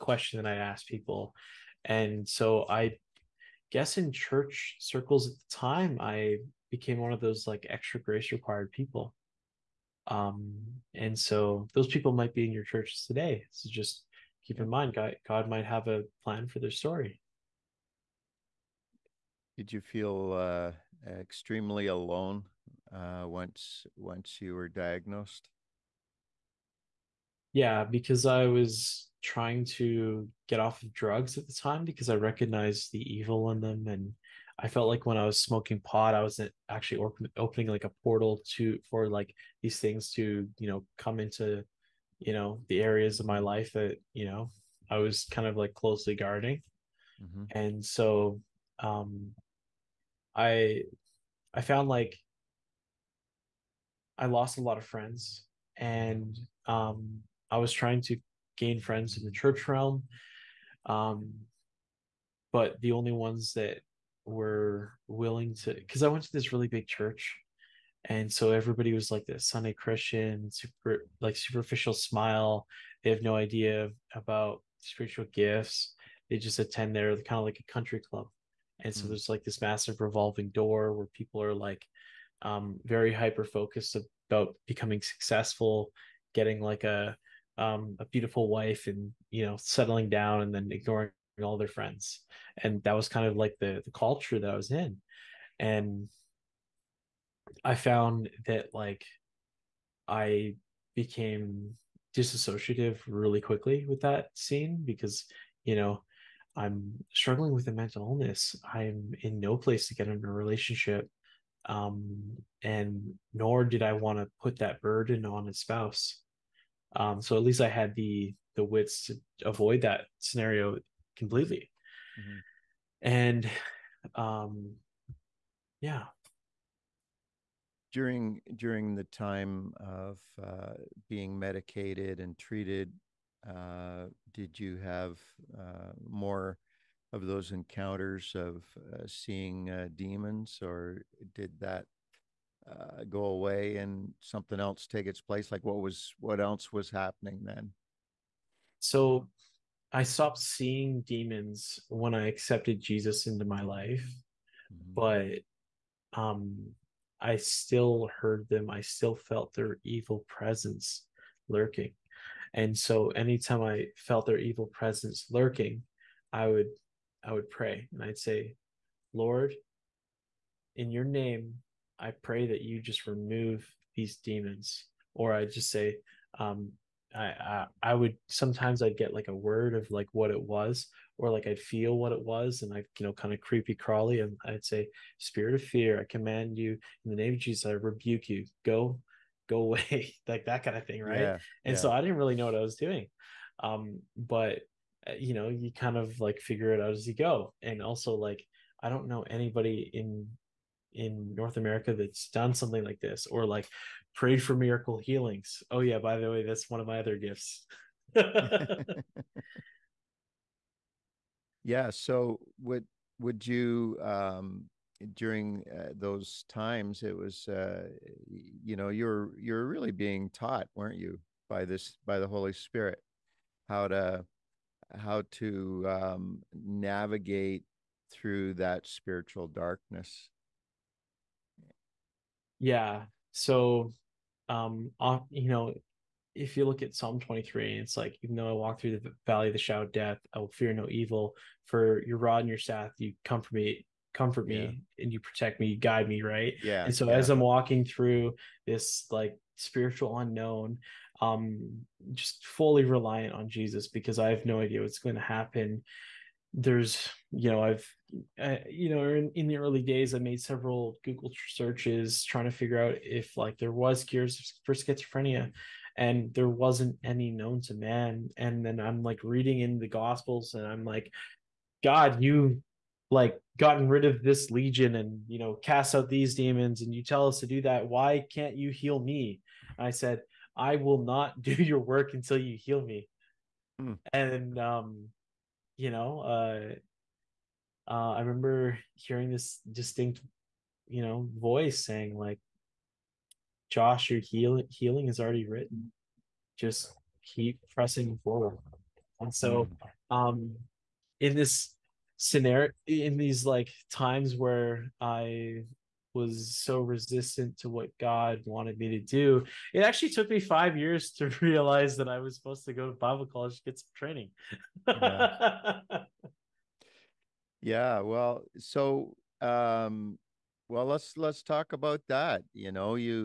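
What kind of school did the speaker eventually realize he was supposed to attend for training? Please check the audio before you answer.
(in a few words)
Bible college.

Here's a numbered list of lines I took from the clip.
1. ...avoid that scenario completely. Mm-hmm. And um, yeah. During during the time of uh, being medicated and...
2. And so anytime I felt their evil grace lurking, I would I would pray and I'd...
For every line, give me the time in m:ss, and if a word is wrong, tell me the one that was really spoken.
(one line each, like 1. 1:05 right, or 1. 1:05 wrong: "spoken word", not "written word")
1. 1:59 right
2. 2:42 wrong: "presence", not "grace".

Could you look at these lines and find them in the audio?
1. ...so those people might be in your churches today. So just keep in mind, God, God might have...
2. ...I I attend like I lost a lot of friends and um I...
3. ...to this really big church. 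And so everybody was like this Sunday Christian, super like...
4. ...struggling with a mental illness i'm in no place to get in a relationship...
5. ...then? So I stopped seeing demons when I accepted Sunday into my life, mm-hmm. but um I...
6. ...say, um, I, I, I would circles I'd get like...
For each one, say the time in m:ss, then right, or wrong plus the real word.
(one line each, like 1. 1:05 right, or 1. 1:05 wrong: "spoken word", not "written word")
1. 0:11 right
2. 0:50 wrong: "found", not "attend"
3. 1:06 right
4. 1:47 right
5. 2:27 wrong: "Jesus", not "Sunday"
6. 2:55 wrong: "sometimes", not "circles".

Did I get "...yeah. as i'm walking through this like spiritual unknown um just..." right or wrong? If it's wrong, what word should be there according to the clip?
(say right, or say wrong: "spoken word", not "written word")
right.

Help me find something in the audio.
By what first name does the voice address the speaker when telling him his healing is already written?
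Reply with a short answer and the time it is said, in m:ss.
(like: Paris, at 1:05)
Josh, at 4:53.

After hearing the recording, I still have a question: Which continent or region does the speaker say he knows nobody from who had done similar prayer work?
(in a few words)
North America.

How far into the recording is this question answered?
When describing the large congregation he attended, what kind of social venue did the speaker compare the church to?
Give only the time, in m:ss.
1:17.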